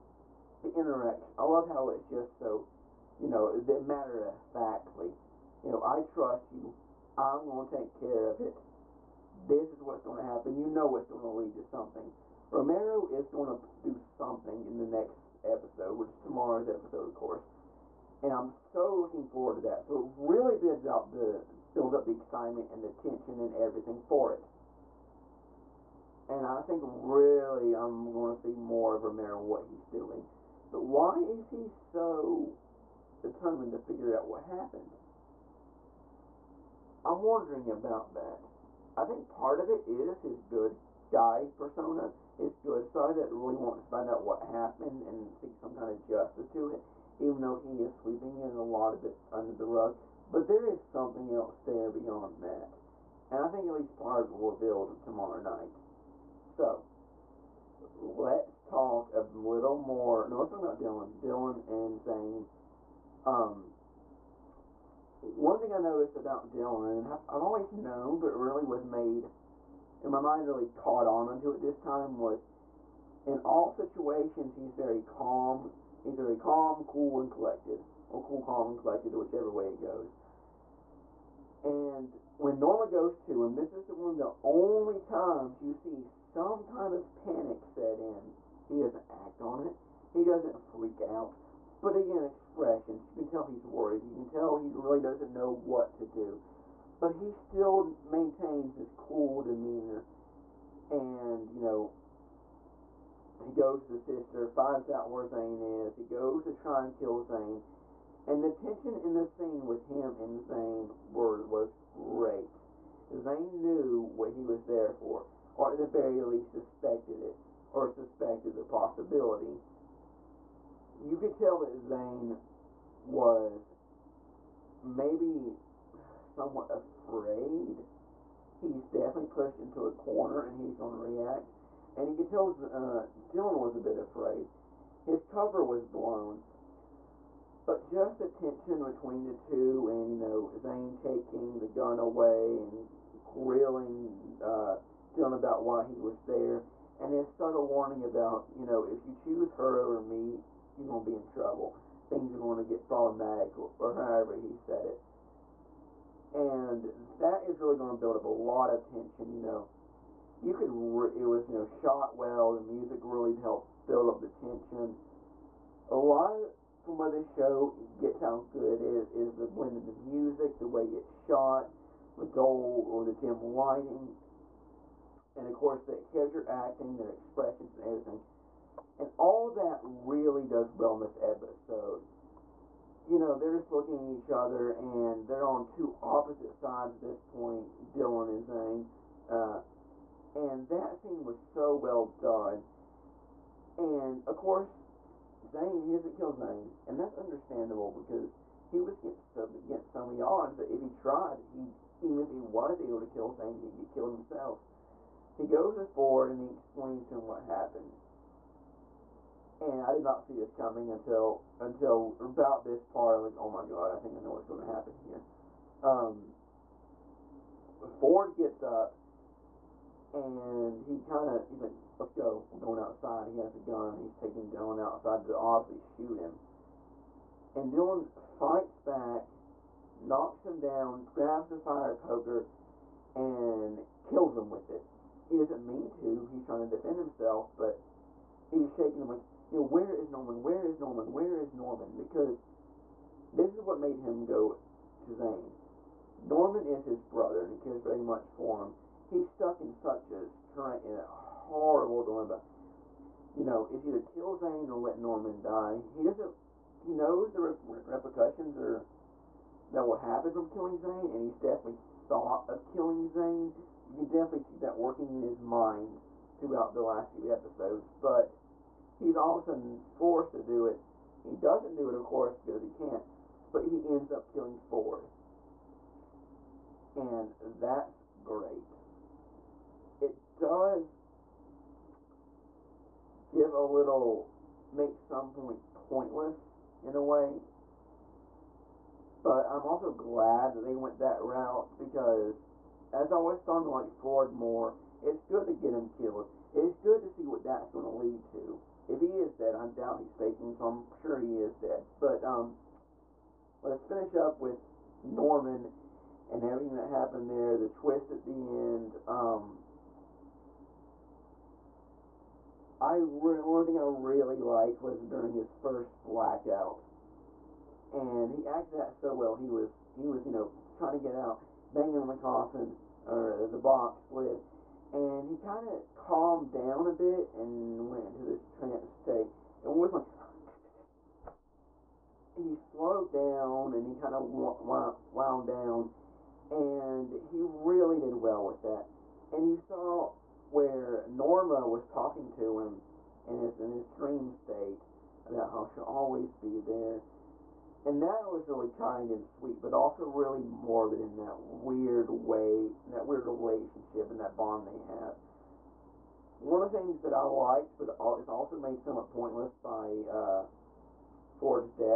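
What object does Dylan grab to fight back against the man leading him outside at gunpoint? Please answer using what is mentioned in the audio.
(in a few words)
Fire poker.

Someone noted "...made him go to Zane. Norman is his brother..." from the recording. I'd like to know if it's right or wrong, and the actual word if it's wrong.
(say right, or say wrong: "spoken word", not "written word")
right.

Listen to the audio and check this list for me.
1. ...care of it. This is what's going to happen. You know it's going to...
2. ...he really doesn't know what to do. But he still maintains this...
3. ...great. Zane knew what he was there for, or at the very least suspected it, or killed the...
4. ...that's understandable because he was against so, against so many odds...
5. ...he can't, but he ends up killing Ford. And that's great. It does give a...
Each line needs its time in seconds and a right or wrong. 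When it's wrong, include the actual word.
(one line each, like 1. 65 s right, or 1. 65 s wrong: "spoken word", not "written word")
1. 7 s right
2. 94 s right
3. 112 s wrong: "suspected", not "killed"
4. 196 s right
5. 272 s right.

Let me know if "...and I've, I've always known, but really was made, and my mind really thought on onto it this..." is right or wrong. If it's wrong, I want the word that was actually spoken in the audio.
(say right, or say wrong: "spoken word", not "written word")
wrong: "caught", not "thought".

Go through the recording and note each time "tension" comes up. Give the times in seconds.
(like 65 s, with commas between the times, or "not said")
22 s, 108 s, 138 s, 158 s, 164 s.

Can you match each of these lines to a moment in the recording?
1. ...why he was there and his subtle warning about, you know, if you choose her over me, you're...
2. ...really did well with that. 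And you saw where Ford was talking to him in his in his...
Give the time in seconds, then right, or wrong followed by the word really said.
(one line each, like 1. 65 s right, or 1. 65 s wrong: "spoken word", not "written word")
1. 145 s right
2. 337 s wrong: "Norma", not "Ford".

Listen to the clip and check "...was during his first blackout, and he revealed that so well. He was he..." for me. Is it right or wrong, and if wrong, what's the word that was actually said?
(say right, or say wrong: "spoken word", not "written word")
wrong: "acted", not "revealed".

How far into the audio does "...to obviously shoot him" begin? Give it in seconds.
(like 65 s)
225 s.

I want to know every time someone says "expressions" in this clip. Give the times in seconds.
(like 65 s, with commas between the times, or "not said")
92 s, 177 s.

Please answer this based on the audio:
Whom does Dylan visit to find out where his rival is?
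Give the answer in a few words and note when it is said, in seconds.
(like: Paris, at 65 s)
The sister, at 103 s.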